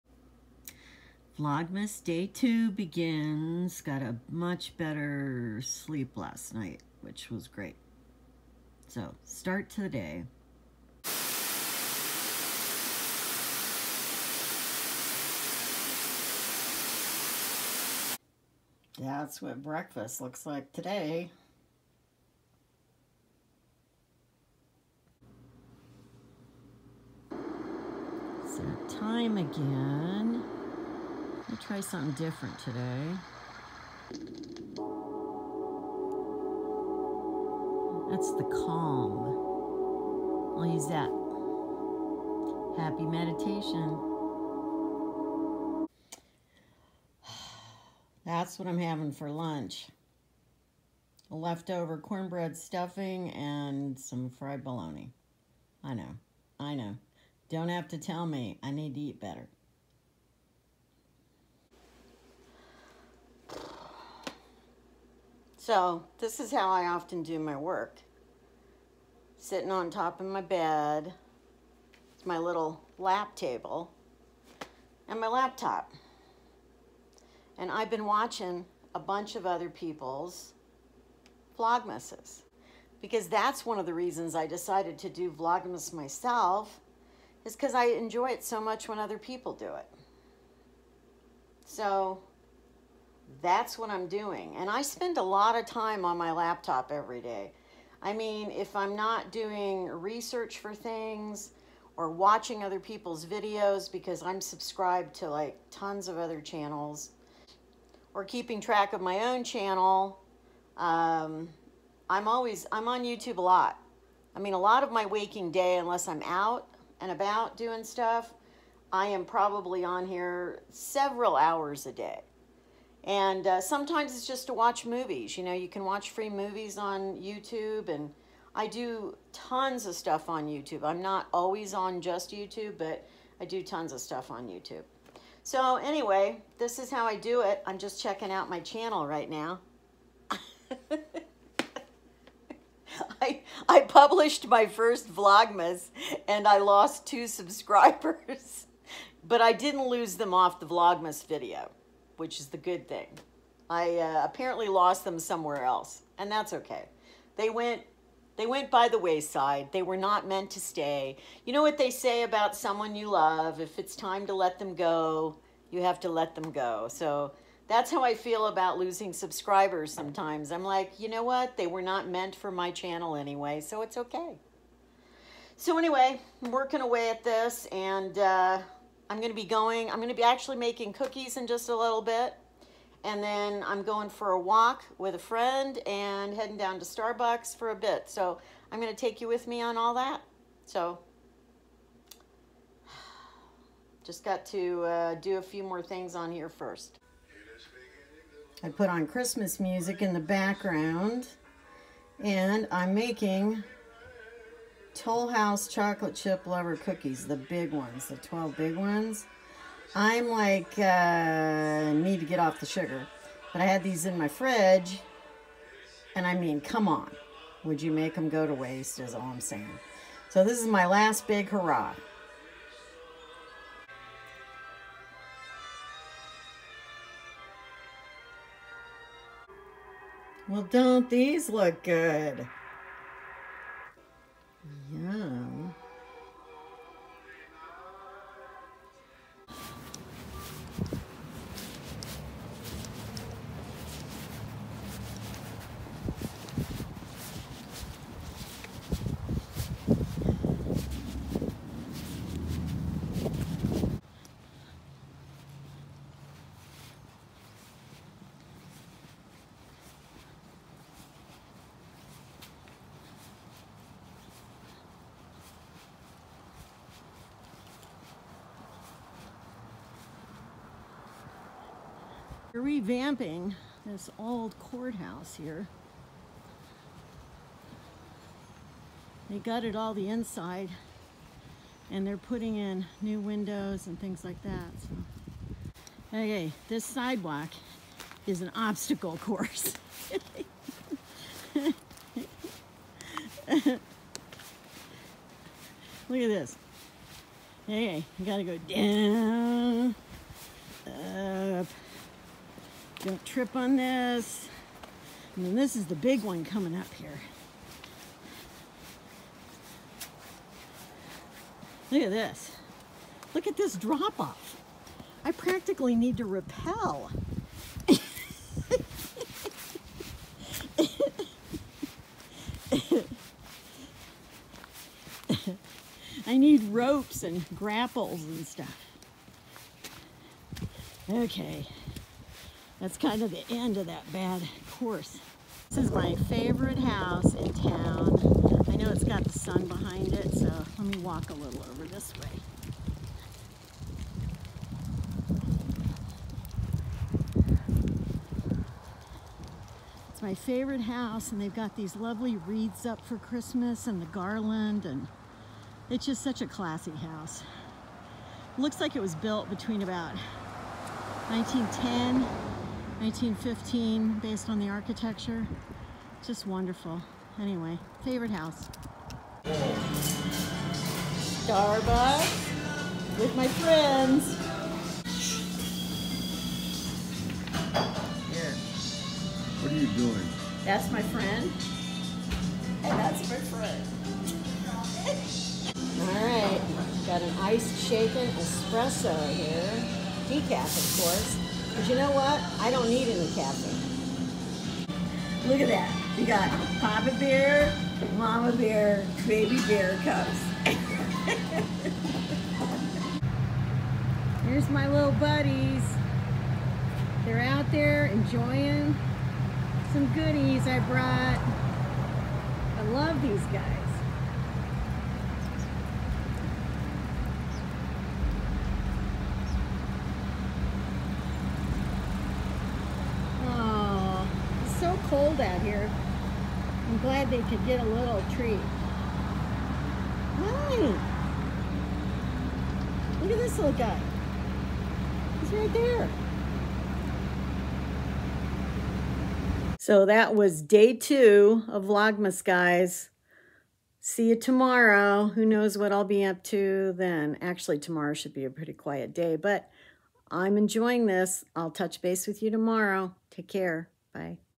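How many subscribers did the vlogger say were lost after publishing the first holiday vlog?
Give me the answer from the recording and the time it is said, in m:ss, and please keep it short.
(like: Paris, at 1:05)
2, at 2:27.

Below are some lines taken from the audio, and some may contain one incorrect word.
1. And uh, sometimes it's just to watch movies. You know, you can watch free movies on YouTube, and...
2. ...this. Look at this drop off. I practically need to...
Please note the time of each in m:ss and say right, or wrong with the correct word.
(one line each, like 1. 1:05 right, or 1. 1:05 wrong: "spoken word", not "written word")
1. 2:03 right
2. 5:12 right.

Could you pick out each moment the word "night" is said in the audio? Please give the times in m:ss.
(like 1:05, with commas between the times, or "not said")
0:06.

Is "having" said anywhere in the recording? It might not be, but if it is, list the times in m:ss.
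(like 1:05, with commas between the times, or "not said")
0:48.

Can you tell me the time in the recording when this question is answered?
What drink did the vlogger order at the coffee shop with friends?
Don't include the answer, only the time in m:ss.
6:27.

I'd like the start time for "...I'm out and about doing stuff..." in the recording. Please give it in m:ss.
1:56.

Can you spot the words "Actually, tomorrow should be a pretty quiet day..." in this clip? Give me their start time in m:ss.
7:27.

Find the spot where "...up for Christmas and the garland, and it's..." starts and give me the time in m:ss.
5:52.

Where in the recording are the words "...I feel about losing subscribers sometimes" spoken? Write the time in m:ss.
2:48.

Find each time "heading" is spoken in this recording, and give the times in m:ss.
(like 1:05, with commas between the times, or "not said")
3:06.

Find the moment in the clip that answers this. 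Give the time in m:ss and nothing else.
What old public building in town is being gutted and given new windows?
4:34.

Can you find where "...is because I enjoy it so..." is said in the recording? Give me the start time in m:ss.
1:27.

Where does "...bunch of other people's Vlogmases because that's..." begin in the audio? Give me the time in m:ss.
1:18.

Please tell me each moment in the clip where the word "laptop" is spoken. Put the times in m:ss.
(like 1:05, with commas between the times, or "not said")
1:15, 1:36.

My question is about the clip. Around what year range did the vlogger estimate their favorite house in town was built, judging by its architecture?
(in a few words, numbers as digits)
1910 to 1915.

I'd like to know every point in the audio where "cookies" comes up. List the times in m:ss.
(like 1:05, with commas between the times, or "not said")
3:00, 3:26.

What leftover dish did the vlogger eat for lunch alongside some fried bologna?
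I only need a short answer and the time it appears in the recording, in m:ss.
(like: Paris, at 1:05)
Cornbread stuffing, at 0:51.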